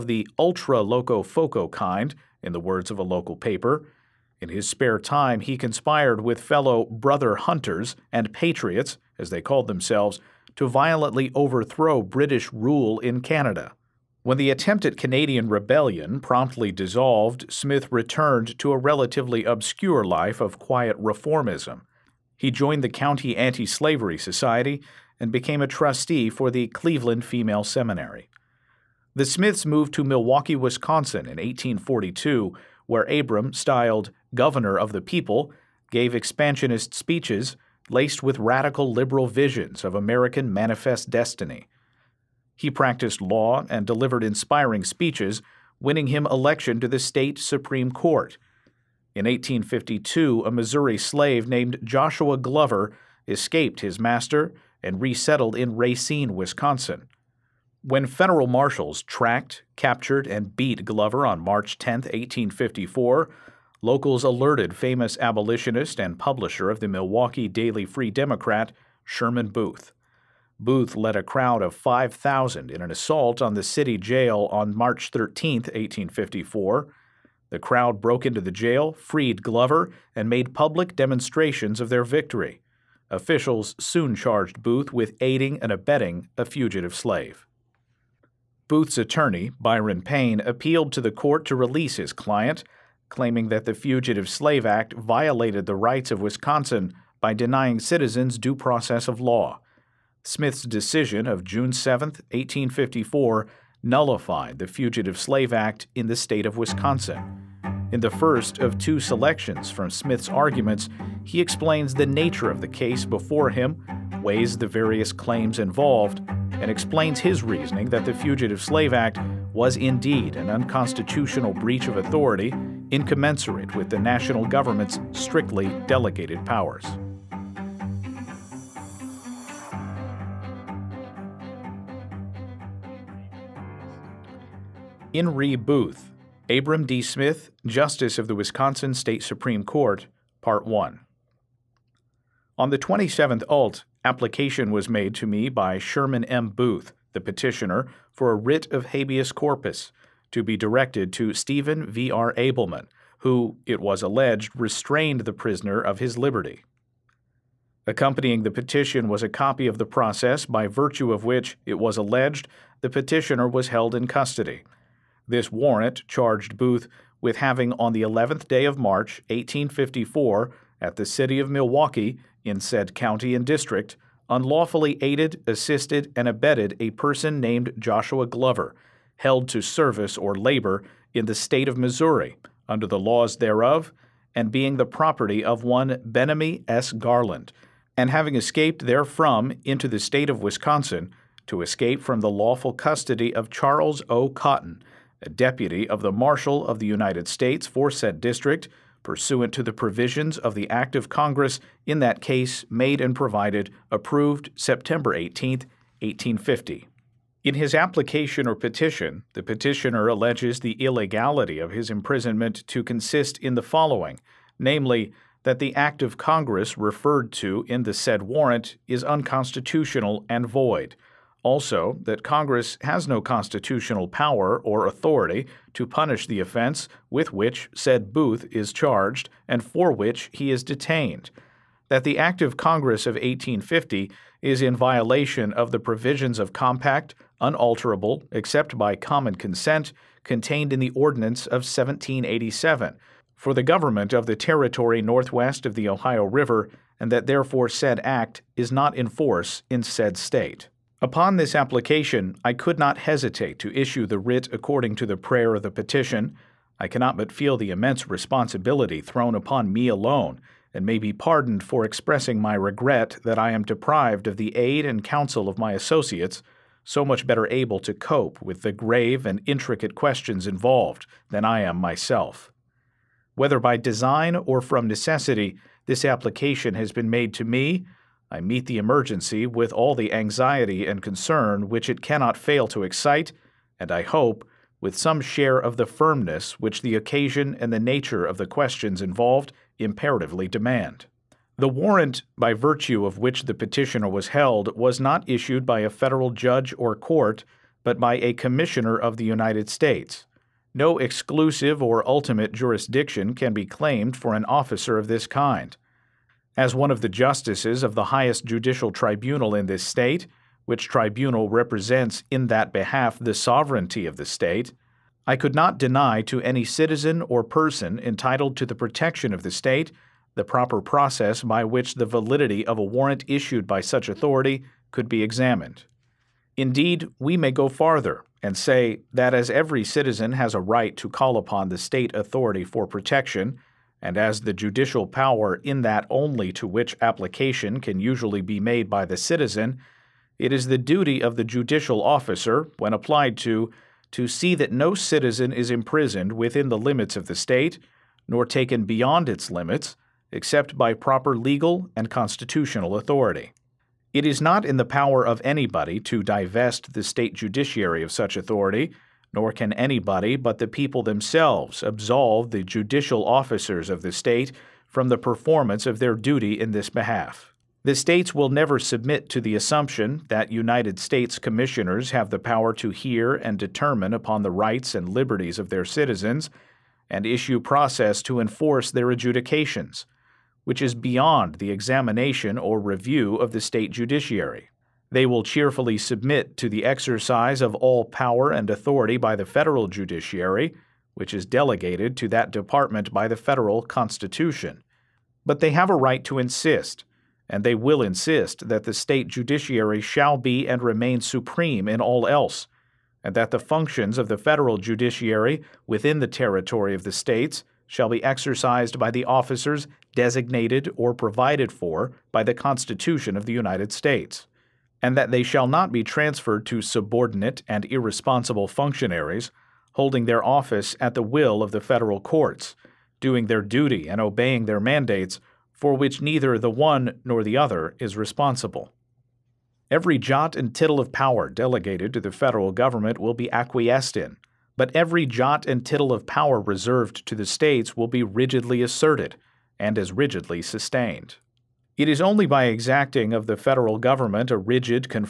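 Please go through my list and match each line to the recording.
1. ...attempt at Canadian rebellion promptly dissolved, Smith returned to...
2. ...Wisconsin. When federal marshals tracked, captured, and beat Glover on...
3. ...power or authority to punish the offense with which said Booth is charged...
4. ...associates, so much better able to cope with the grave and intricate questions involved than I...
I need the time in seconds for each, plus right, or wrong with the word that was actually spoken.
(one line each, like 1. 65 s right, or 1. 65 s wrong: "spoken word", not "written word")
1. 14 s right
2. 56 s right
3. 224 s right
4. 265 s right.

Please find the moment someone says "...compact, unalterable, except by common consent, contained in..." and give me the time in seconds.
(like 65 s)
236 s.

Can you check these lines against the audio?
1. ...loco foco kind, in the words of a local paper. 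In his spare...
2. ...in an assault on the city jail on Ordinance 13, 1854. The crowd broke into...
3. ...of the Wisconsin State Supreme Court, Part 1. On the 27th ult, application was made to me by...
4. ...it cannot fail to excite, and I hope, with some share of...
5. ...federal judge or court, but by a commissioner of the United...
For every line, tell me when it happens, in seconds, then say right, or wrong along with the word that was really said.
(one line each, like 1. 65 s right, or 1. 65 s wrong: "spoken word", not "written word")
1. 0 s right
2. 72 s wrong: "March", not "Ordinance"
3. 138 s right
4. 281 s right
5. 295 s right.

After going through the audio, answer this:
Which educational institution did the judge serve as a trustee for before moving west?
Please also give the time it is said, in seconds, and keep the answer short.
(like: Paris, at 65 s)
Cleveland Female Seminary, at 26 s.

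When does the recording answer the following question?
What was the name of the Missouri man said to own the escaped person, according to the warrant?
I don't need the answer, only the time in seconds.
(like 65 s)
186 s.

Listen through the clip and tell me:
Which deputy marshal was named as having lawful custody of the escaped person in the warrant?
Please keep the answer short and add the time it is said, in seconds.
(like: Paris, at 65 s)
Charles O. Cotton, at 193 s.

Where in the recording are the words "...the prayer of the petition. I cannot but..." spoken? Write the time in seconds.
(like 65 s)
255 s.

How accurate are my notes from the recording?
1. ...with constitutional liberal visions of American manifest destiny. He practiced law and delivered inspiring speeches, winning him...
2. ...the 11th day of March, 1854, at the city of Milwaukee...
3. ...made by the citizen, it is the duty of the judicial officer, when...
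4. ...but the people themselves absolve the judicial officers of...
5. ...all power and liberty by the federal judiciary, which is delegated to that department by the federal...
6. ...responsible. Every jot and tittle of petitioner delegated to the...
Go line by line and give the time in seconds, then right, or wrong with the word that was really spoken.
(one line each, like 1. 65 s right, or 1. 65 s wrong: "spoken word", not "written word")
1. 38 s wrong: "radical", not "constitutional"
2. 167 s right
3. 338 s right
4. 360 s right
5. 387 s wrong: "authority", not "liberty"
6. 428 s wrong: "power", not "petitioner".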